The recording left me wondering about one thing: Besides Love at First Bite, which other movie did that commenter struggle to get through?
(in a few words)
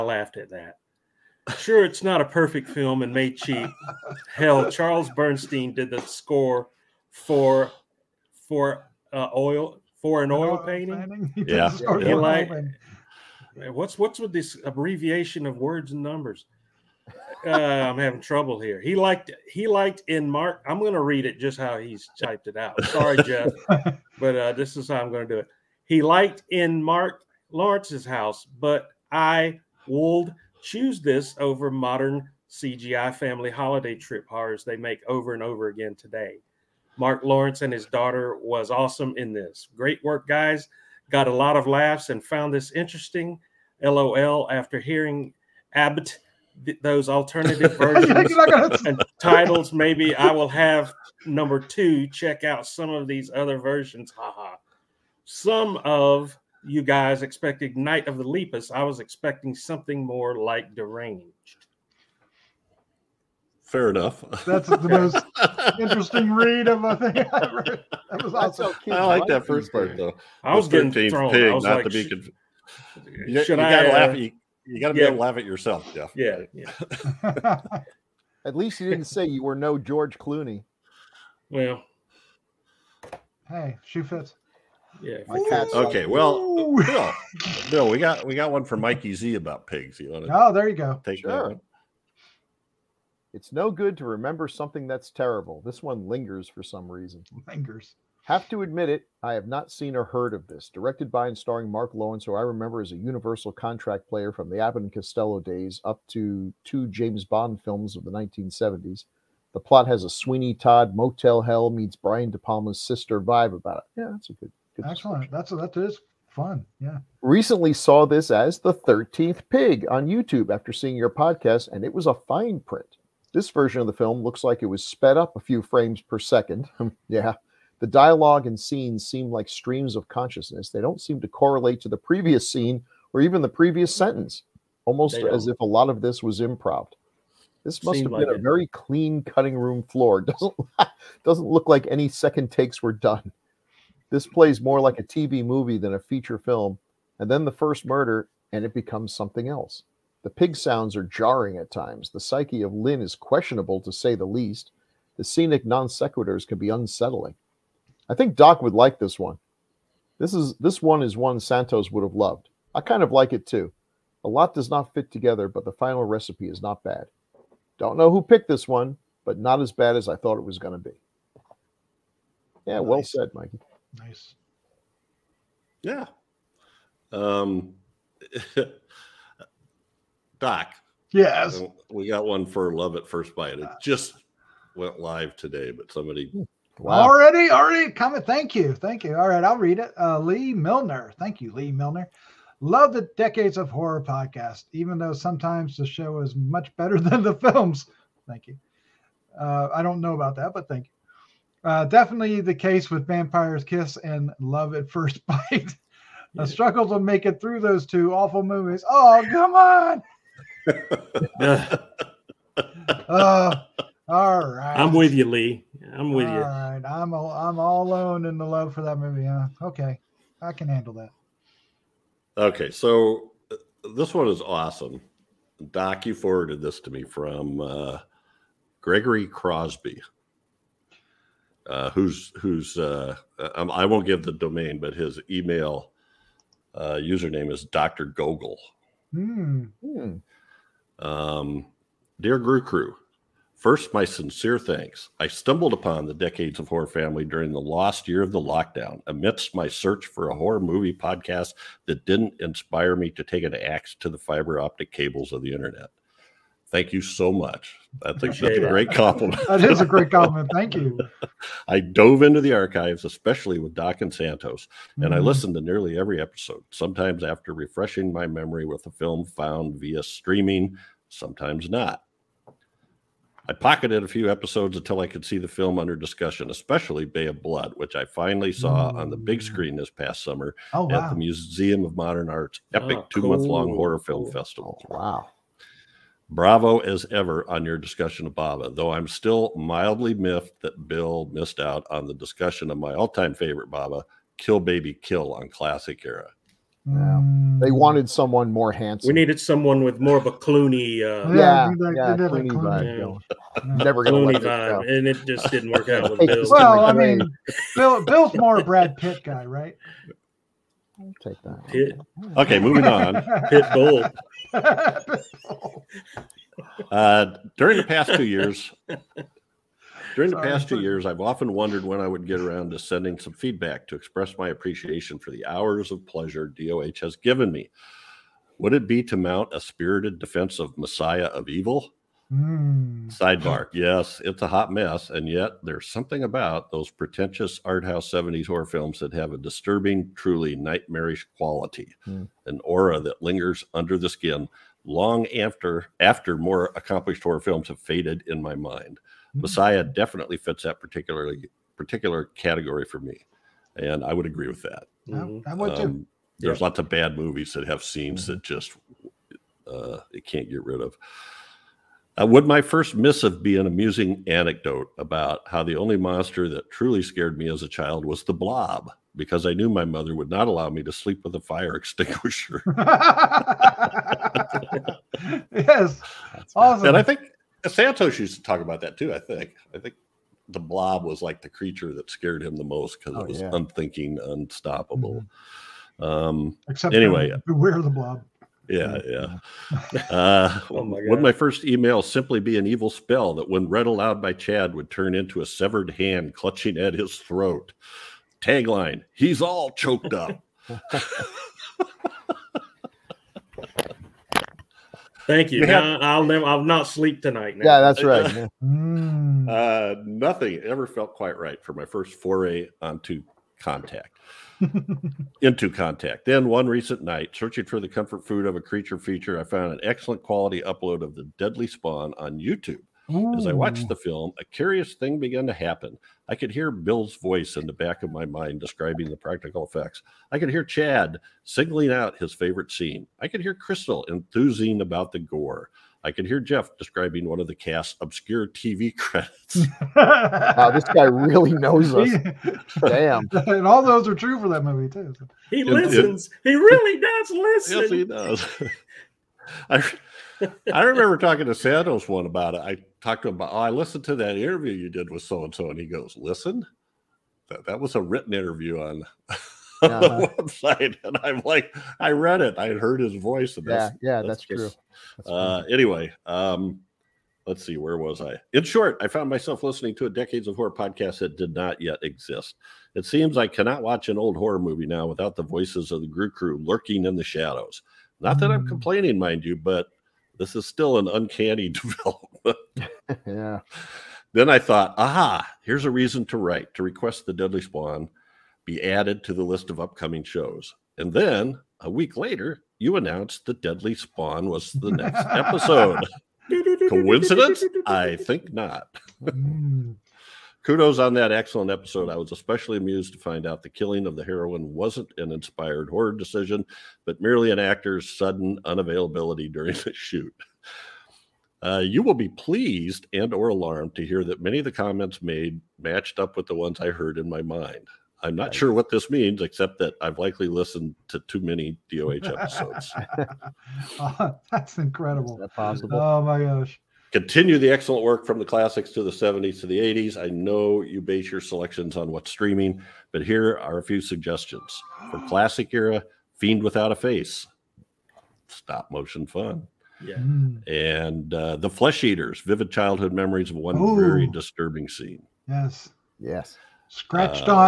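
Vampire's Kiss.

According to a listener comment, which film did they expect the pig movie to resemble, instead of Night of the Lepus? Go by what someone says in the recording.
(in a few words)
Deranged.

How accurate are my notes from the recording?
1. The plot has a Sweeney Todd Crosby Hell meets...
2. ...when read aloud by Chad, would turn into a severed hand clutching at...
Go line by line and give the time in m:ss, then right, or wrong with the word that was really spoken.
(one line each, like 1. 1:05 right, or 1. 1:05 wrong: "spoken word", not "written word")
1. 1:49 wrong: "Motel", not "Crosby"
2. 6:33 right.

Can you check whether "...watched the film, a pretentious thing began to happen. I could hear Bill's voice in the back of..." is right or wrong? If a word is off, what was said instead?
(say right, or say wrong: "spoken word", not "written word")
wrong: "curious", not "pretentious".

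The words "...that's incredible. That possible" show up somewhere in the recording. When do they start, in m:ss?
8:44.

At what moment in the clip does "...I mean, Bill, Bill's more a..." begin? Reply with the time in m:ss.
5:06.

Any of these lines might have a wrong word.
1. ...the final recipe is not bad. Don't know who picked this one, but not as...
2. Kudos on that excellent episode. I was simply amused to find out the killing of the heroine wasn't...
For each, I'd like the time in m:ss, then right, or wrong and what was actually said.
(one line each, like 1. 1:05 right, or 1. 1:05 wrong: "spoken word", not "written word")
1. 2:45 right
2. 8:20 wrong: "especially", not "simply".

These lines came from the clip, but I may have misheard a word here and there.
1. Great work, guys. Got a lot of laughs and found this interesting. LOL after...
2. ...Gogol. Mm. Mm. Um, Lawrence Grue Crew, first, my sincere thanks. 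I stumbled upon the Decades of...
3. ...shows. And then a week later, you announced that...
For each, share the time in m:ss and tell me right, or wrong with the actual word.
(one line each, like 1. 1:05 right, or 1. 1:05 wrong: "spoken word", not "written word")
1. 0:39 right
2. 3:58 wrong: "Dear", not "Lawrence"
3. 8:10 right.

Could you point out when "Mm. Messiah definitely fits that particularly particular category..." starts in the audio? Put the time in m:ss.
5:49.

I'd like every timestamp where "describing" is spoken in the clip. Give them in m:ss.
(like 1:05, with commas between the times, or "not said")
7:08, 7:16.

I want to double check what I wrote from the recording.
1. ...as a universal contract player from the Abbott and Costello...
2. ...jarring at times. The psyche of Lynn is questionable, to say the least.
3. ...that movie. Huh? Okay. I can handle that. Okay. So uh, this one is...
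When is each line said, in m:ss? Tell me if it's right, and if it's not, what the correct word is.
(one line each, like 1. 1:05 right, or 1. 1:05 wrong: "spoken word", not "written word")
1. 1:42 right
2. 2:31 right
3. 3:38 right.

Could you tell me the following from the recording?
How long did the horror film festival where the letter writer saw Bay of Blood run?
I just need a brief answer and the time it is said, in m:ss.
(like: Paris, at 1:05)
2 months, at 4:43.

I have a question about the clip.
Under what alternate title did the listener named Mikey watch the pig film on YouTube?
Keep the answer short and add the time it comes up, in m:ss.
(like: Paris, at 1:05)
The 13th Pig, at 1:58.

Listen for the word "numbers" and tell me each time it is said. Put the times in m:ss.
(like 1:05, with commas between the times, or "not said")
0:16, 0:51.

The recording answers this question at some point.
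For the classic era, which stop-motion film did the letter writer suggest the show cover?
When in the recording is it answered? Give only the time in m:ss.
8:56.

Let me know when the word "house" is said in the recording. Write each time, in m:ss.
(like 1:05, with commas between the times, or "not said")
0:28, 5:37.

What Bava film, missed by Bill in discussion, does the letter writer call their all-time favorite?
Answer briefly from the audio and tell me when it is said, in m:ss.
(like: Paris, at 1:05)
Kill Baby Kill, at 4:54.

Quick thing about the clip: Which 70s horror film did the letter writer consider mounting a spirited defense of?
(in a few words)
Messiah of Evil.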